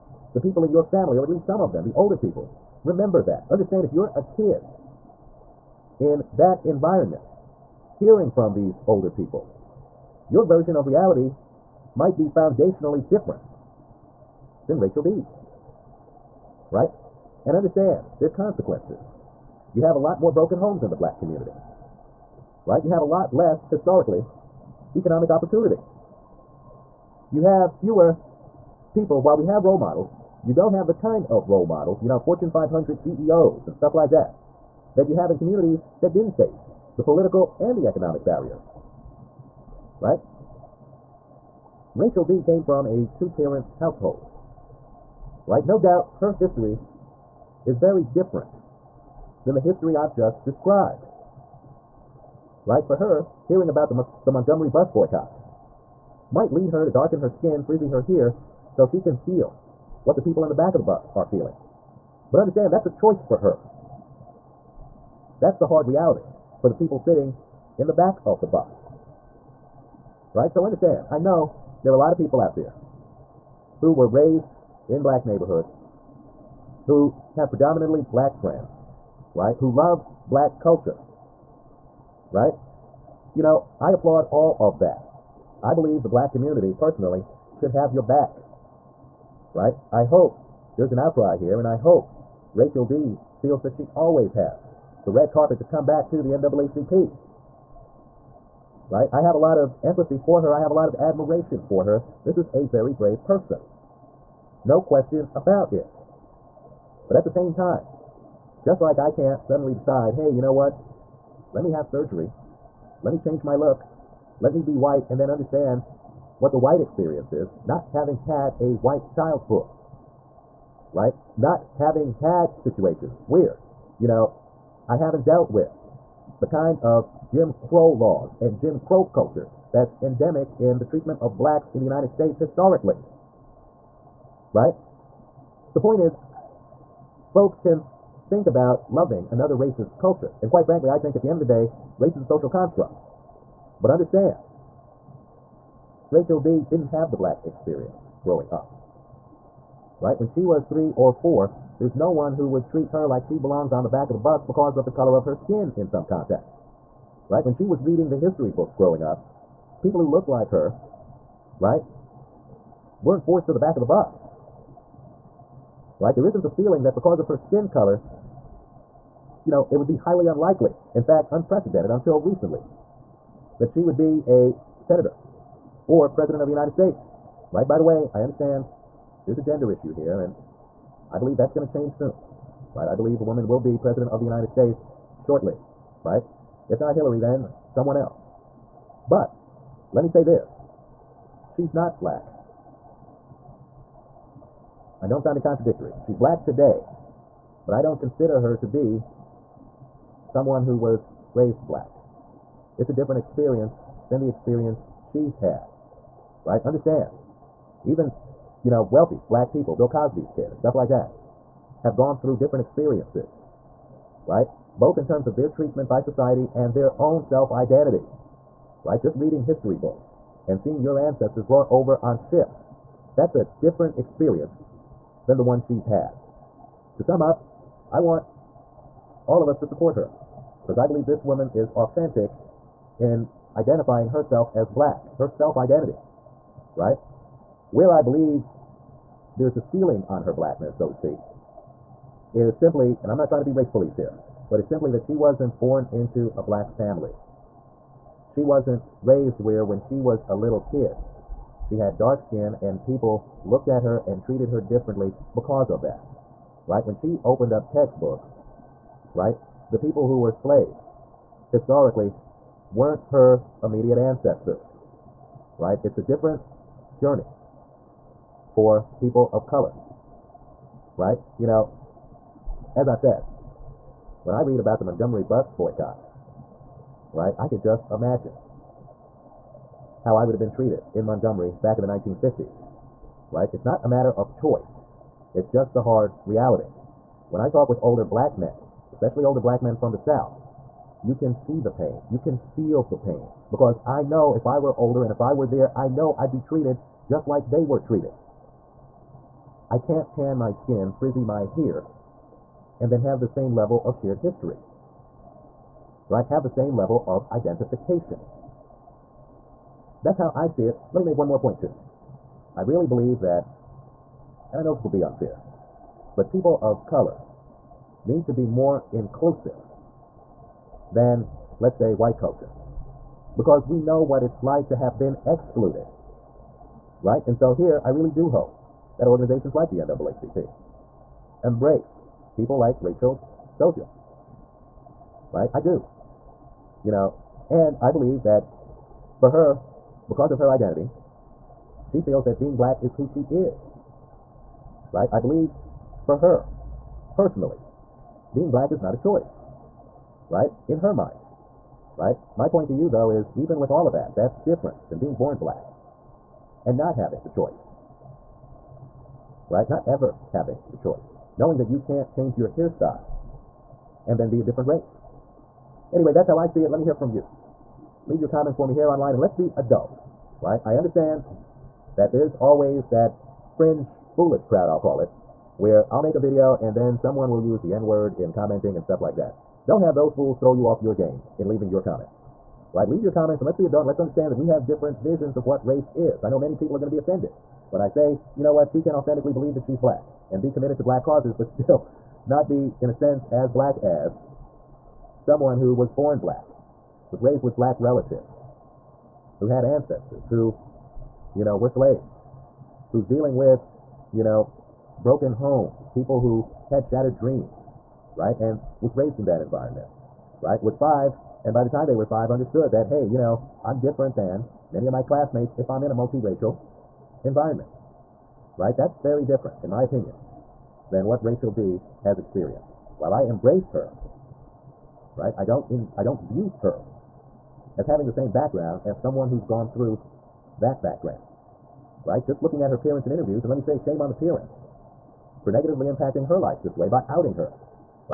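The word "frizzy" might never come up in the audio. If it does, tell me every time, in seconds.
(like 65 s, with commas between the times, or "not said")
57 s, 300 s.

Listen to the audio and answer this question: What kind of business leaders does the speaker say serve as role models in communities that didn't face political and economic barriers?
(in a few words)
Fortune 500 CEOs.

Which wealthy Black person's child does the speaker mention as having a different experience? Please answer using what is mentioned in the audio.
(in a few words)
Bill Cosby.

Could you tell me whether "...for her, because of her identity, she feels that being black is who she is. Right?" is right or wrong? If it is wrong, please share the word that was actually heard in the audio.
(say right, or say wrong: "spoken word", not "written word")
right.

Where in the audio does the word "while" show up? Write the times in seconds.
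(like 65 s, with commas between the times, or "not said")
29 s, 422 s.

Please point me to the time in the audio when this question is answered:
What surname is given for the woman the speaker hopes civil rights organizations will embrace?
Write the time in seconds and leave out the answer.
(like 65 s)
332 s.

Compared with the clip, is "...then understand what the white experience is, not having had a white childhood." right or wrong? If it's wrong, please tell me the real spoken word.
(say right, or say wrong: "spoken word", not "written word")
right.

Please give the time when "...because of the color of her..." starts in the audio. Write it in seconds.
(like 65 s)
154 s.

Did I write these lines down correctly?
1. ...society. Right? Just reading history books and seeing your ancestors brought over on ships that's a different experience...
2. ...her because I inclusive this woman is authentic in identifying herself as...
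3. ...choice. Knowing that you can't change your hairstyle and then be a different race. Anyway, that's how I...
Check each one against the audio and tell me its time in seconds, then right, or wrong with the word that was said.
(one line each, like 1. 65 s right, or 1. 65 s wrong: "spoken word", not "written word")
1. 217 s wrong: "identity", not "society"
2. 229 s wrong: "believe", not "inclusive"
3. 360 s right.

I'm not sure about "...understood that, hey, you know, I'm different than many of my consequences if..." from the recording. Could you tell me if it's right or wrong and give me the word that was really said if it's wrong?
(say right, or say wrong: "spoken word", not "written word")
wrong: "classmates", not "consequences".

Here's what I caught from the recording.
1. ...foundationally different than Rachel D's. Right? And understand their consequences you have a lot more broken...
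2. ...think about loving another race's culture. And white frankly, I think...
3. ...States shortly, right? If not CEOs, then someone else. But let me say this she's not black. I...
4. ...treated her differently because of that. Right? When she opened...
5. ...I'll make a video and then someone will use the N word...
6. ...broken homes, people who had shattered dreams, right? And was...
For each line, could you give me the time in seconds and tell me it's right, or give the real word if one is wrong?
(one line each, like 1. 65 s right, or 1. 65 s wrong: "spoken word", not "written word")
1. 12 s right
2. 138 s wrong: "quite", not "white"
3. 184 s wrong: "Hillary", not "CEOs"
4. 254 s right
5. 375 s right
6. 405 s right.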